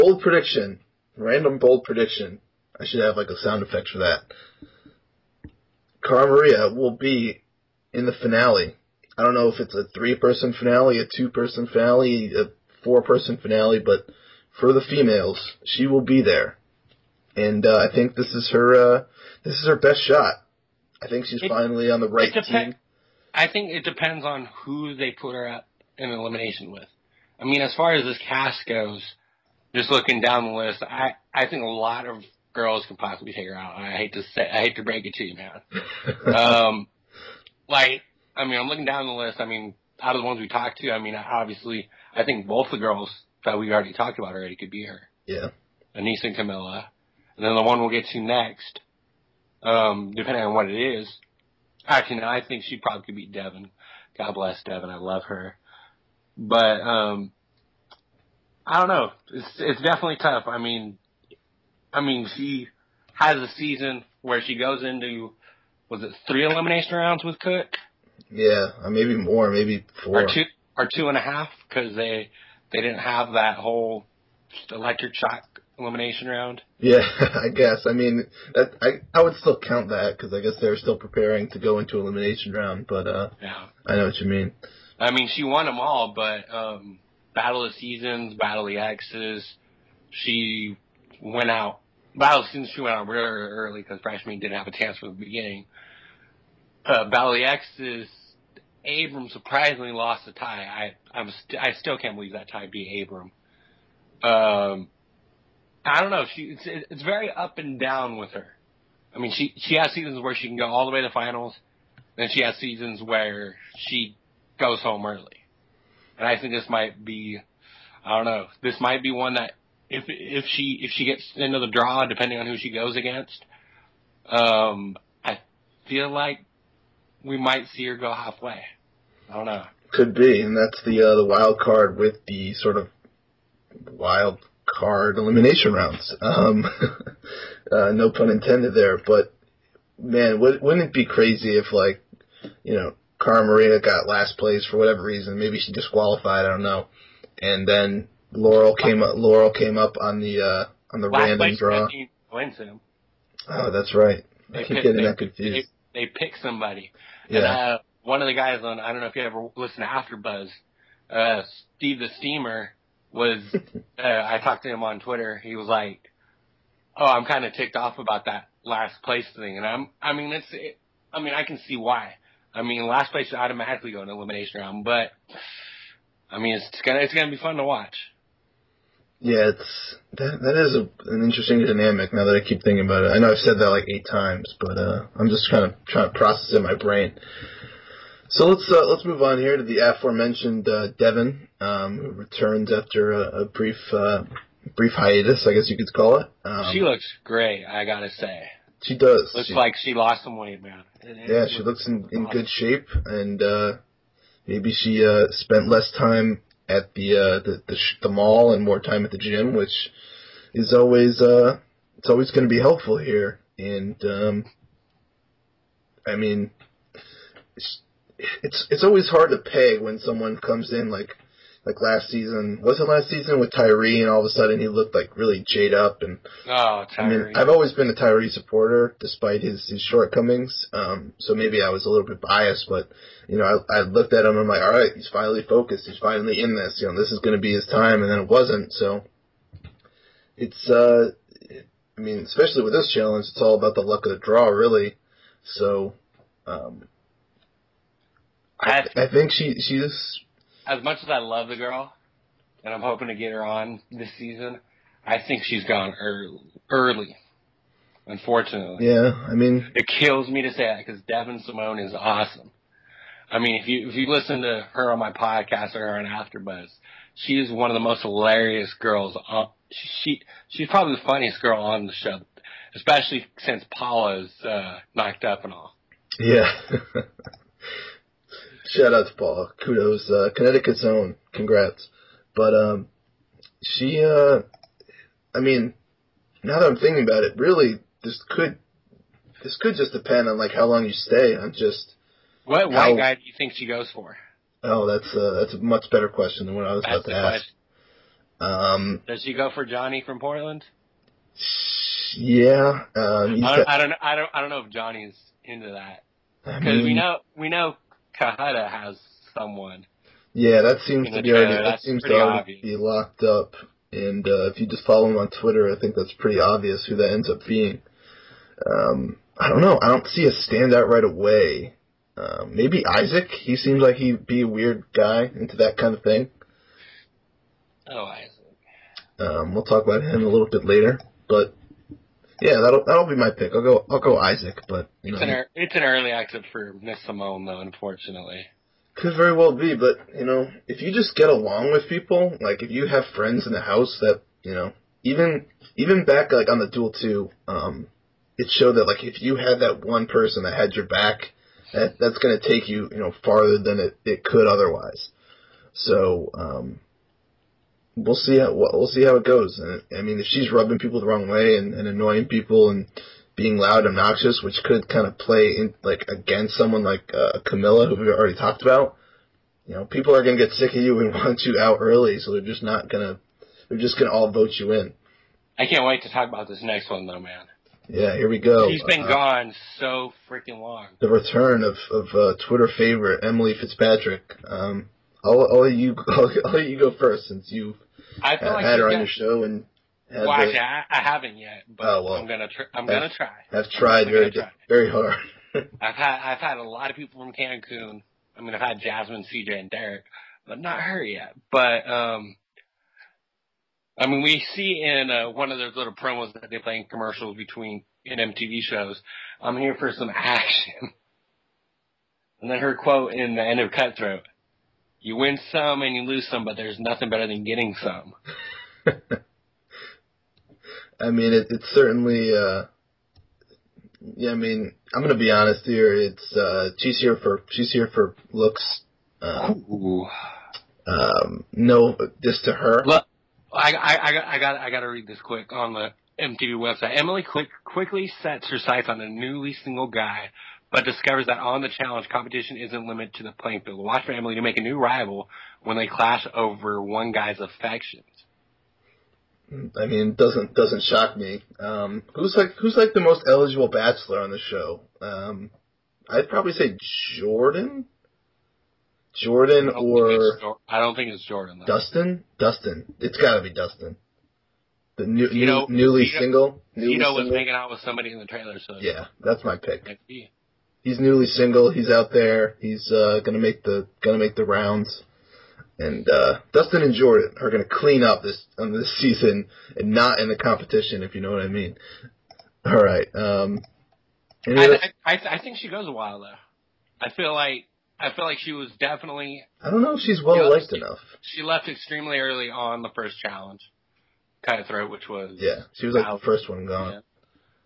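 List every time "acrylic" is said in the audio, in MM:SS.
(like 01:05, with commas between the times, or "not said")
not said.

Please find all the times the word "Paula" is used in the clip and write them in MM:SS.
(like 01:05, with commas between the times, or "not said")
04:33, 04:39.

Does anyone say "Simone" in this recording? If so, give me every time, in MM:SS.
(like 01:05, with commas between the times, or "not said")
04:21, 05:37.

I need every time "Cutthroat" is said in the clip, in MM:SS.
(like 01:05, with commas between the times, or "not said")
06:53, 08:14.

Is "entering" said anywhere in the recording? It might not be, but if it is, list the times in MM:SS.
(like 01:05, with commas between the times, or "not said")
not said.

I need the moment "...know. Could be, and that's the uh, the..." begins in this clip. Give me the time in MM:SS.
02:09.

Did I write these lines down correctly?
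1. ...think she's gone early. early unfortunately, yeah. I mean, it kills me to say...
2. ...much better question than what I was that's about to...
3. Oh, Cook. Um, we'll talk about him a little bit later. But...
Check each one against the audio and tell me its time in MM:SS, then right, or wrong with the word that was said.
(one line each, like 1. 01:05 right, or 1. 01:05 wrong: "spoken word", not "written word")
1. 04:15 right
2. 04:55 right
3. 05:27 wrong: "Isaac", not "Cook".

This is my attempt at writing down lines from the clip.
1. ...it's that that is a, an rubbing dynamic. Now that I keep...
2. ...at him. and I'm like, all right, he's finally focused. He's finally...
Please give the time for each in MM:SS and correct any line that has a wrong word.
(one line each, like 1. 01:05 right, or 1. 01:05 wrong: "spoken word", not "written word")
1. 02:59 wrong: "interesting", not "rubbing"
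2. 03:54 right.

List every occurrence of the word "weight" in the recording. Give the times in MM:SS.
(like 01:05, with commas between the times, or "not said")
03:20.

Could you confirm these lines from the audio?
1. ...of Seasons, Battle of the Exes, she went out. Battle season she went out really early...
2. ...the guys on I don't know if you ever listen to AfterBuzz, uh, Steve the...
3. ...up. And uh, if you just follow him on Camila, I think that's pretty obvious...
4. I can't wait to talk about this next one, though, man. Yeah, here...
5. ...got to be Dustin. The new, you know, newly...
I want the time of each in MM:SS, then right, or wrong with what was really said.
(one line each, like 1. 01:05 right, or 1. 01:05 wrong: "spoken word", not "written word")
1. 01:27 right
2. 02:38 right
3. 05:13 wrong: "Twitter", not "Camila"
4. 06:15 right
5. 07:43 right.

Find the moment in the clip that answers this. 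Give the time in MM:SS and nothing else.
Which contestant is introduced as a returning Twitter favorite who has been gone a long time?
06:23.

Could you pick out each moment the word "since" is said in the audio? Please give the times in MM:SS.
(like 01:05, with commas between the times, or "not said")
04:33, 06:27.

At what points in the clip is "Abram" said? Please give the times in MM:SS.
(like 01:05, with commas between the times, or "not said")
01:38, 01:43.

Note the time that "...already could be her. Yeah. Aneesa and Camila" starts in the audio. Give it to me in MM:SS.
00:44.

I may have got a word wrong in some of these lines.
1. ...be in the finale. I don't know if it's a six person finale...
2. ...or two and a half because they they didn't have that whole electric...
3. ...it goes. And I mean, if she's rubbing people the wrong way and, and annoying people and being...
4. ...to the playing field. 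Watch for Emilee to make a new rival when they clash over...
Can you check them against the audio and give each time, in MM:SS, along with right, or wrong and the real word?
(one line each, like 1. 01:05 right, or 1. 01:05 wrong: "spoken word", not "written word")
1. 00:06 wrong: "three", not "six"
2. 01:10 right
3. 05:59 right
4. 07:23 right.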